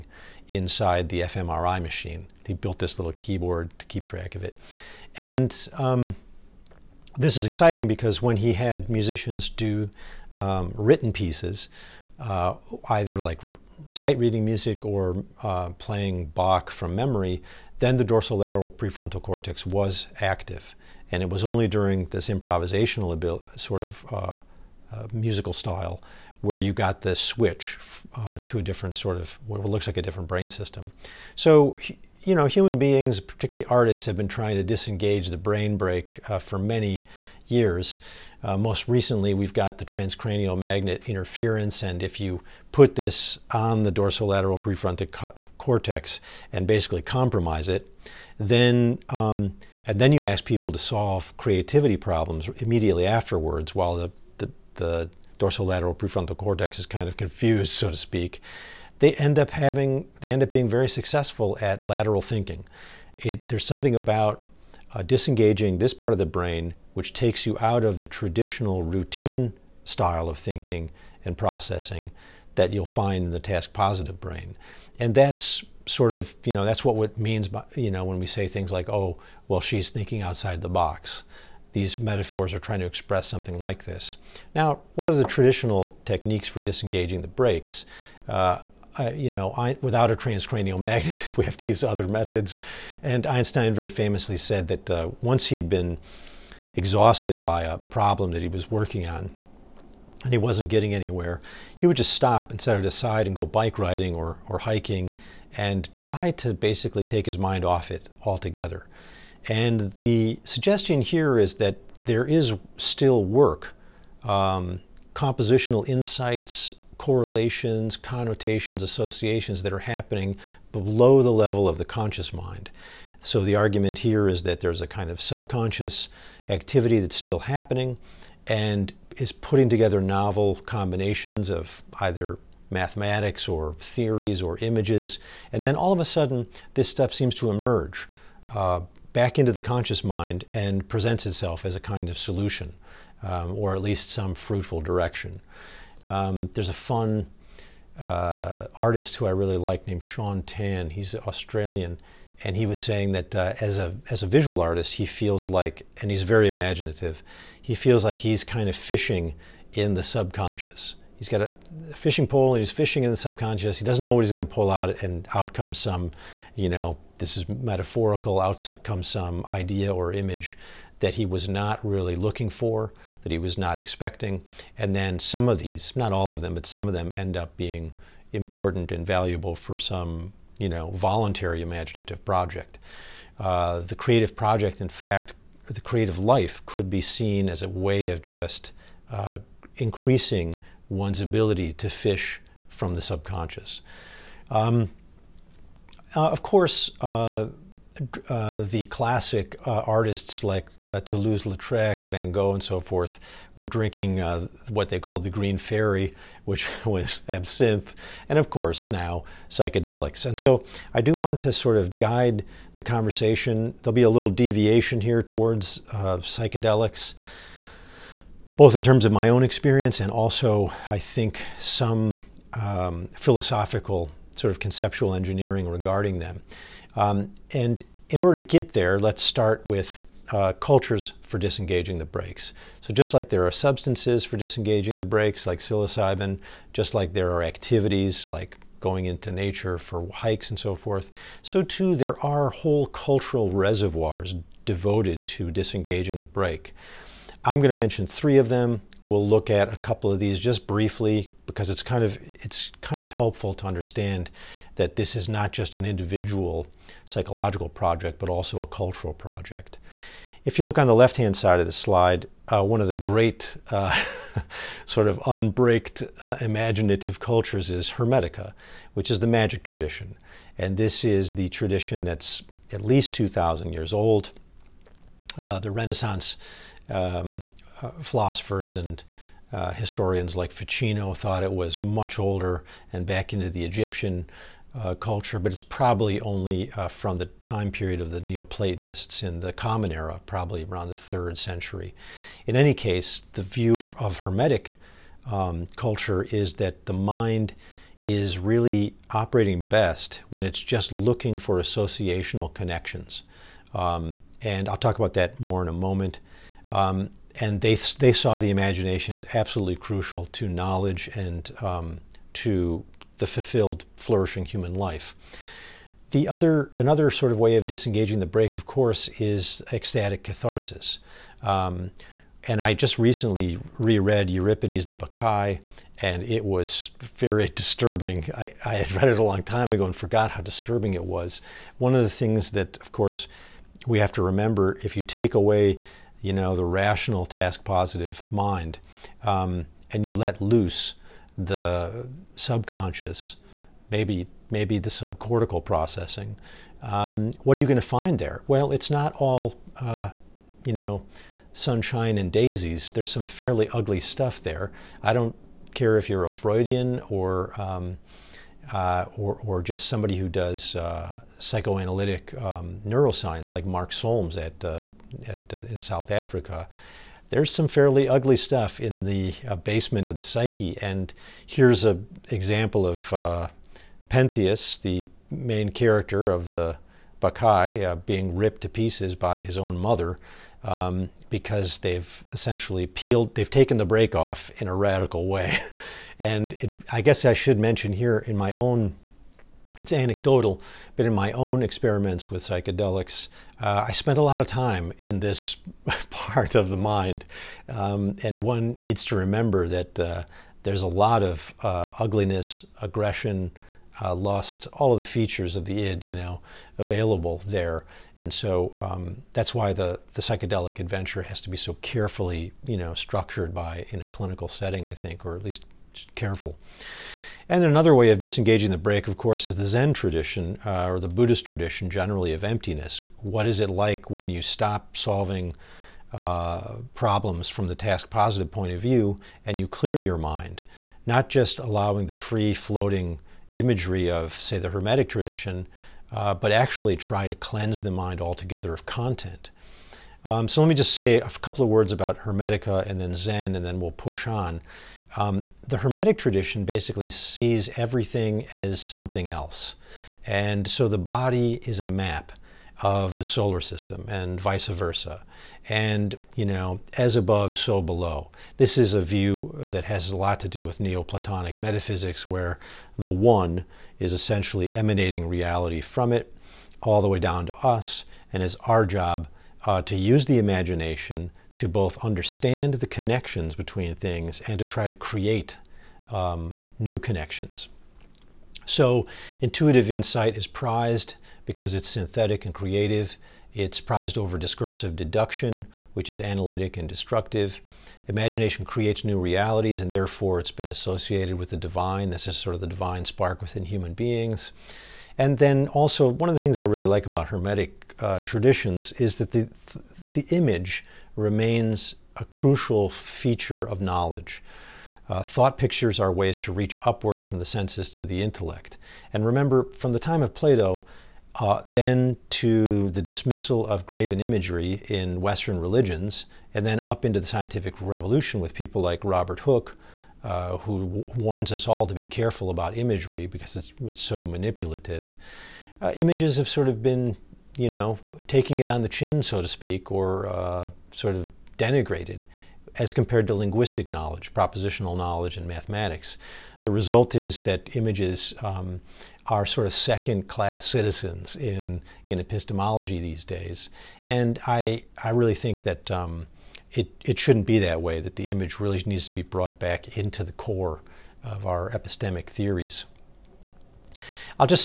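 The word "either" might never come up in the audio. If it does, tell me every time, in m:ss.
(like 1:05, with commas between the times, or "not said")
0:12, 2:12.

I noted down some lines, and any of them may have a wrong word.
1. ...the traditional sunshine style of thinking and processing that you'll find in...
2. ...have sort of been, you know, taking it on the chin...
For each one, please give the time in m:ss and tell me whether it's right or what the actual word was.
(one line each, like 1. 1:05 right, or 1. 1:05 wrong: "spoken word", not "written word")
1. 1:07 wrong: "routine", not "sunshine"
2. 8:46 right.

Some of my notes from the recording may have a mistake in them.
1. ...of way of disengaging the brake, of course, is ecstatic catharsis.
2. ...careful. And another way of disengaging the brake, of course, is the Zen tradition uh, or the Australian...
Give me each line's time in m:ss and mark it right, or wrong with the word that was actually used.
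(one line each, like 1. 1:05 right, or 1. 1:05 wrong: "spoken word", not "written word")
1. 5:17 right
2. 6:56 wrong: "Buddhist", not "Australian".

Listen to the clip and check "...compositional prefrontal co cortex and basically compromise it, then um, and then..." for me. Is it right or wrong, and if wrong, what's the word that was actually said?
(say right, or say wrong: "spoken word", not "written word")
wrong: "dorsolateral", not "compositional".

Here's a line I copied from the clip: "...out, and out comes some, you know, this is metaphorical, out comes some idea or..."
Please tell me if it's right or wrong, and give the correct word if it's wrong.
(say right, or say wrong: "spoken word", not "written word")
right.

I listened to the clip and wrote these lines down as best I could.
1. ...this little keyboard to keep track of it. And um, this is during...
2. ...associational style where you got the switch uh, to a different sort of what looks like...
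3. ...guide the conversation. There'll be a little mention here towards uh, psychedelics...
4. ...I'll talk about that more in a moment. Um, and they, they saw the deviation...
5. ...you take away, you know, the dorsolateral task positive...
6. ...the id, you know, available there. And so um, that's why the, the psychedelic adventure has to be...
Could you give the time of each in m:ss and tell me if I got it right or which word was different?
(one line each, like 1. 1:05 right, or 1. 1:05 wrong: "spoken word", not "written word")
1. 0:02 wrong: "exciting", not "during"
2. 0:25 wrong: "musical", not "associational"
3. 3:31 wrong: "deviation", not "mention"
4. 5:04 wrong: "imagination", not "deviation"
5. 5:34 wrong: "rational", not "dorsolateral"
6. 6:45 right.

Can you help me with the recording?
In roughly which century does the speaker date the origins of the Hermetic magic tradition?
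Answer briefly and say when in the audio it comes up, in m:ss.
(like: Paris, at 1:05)
Third century, at 4:50.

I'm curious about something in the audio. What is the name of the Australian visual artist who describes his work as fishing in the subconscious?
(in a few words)
Shaun Tan.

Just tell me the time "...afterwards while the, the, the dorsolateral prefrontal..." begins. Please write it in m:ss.
0:53.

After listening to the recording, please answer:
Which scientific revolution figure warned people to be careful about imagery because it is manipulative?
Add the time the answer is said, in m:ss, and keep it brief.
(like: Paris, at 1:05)
Robert Hooke, at 8:39.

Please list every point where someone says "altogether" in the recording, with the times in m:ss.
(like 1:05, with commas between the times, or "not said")
1:48, 7:18.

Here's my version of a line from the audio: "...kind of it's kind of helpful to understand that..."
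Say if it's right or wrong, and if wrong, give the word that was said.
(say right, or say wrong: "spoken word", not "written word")
right.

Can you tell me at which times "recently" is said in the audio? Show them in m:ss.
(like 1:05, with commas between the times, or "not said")
0:38, 5:22.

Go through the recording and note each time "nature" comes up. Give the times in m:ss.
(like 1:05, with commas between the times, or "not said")
3:59.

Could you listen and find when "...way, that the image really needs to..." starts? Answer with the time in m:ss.
9:07.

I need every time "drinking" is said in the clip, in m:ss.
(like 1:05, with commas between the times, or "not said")
3:23.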